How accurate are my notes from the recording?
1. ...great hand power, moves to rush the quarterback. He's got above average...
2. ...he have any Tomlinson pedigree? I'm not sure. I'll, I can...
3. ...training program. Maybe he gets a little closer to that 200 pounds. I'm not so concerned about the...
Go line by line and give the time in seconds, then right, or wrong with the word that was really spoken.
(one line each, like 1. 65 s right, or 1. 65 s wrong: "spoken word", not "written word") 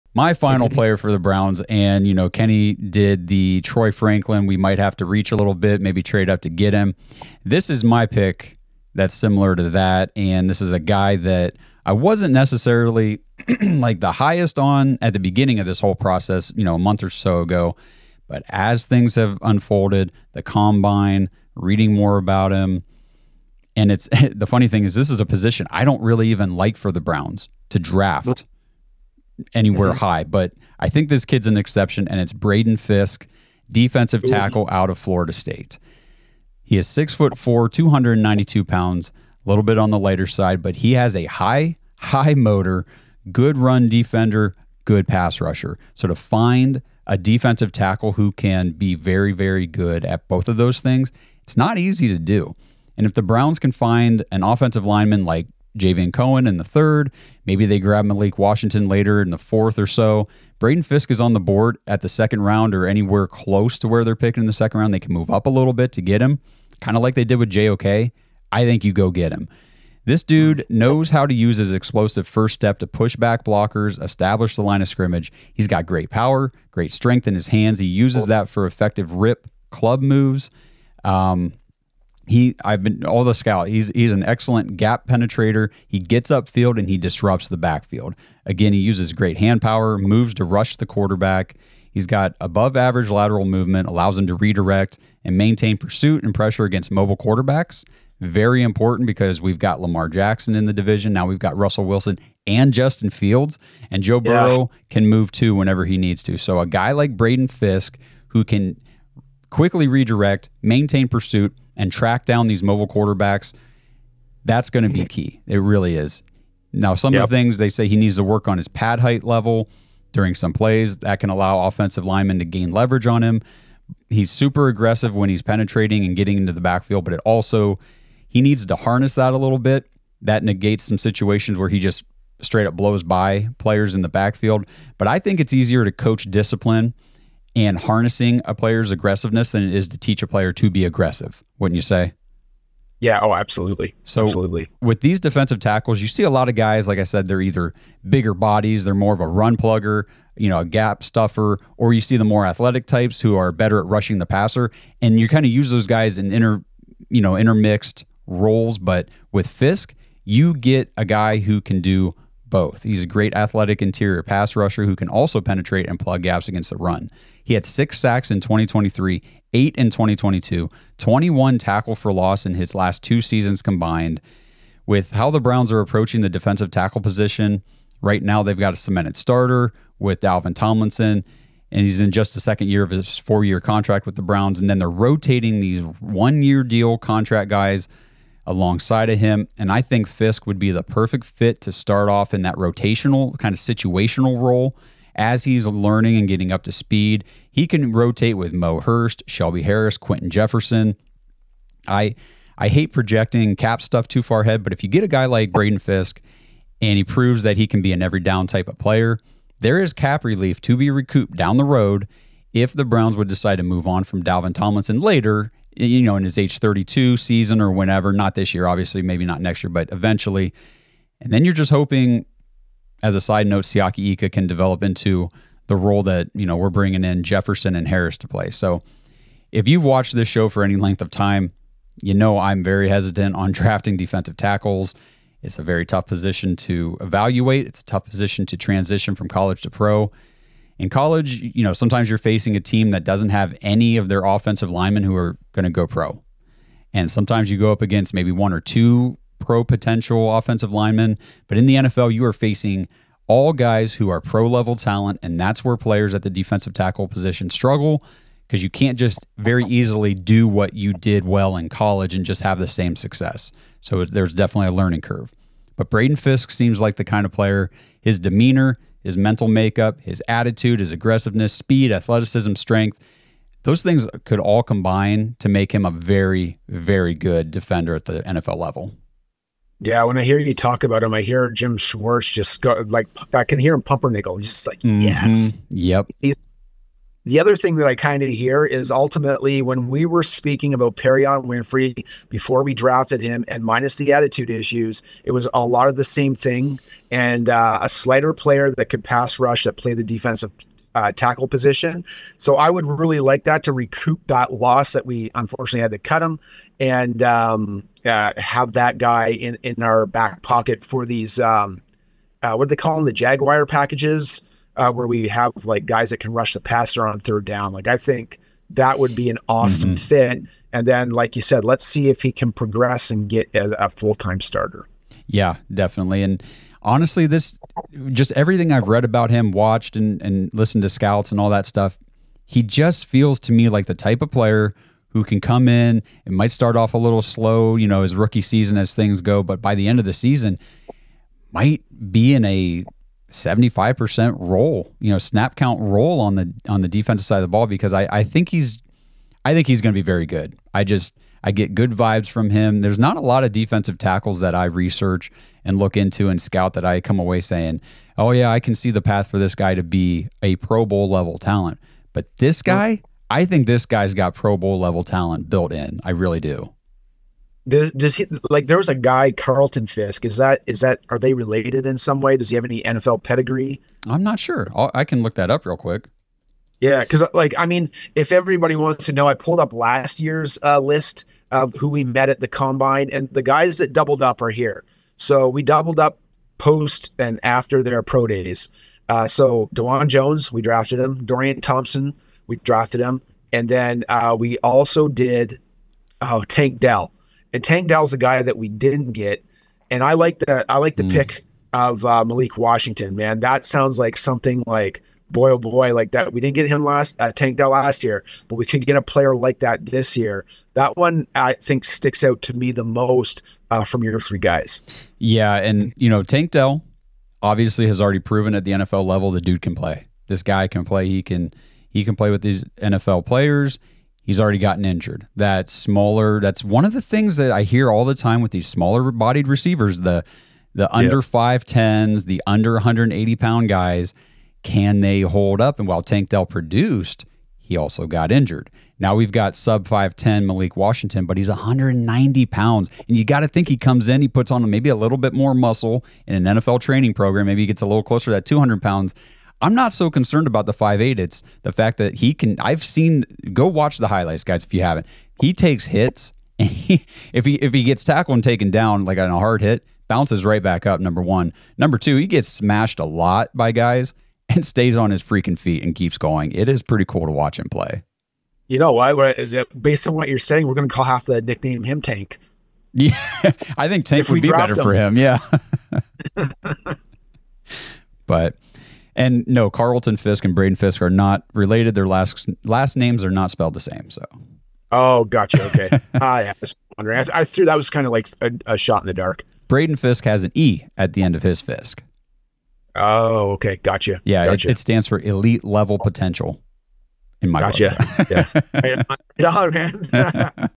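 1. 89 s right
2. 372 s wrong: "NFL", not "Tomlinson"
3. 446 s right.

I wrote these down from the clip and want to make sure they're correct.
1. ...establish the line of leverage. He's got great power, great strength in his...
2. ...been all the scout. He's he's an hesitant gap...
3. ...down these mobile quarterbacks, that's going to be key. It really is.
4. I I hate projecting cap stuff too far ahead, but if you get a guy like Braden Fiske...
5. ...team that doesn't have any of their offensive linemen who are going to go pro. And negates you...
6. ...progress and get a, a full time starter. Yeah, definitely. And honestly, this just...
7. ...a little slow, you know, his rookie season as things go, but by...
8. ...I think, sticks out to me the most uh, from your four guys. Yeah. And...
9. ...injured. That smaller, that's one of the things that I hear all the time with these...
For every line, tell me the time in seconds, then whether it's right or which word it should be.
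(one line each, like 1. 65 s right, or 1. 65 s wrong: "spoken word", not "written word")
1. 74 s wrong: "scrimmage", not "leverage"
2. 82 s wrong: "excellent", not "hesitant"
3. 112 s right
4. 201 s right
5. 242 s wrong: "sometimes", not "negates"
6. 322 s right
7. 336 s right
8. 411 s wrong: "three", not "four"
9. 424 s right.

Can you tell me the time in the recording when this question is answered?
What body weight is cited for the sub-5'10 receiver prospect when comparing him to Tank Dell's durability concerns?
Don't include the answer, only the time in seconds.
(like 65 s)
441 s.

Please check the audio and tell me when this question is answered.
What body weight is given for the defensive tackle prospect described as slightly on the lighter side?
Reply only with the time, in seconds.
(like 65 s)
37 s.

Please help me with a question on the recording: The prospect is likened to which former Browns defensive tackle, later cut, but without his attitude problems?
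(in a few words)
Perrion Winfrey.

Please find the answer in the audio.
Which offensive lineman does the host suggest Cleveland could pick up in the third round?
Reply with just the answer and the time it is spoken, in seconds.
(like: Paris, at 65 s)
Javion Cohen, at 55 s.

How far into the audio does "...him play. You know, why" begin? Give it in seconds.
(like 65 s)
467 s.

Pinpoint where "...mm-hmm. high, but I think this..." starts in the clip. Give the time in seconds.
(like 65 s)
29 s.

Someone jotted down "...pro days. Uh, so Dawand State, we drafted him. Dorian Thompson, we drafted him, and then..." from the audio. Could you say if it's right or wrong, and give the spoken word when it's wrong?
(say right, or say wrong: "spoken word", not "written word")
wrong: "Jones", not "State".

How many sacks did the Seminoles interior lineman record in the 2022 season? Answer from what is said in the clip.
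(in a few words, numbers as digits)
8.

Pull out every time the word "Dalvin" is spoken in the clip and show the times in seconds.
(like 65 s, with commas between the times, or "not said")
180 s, 214 s.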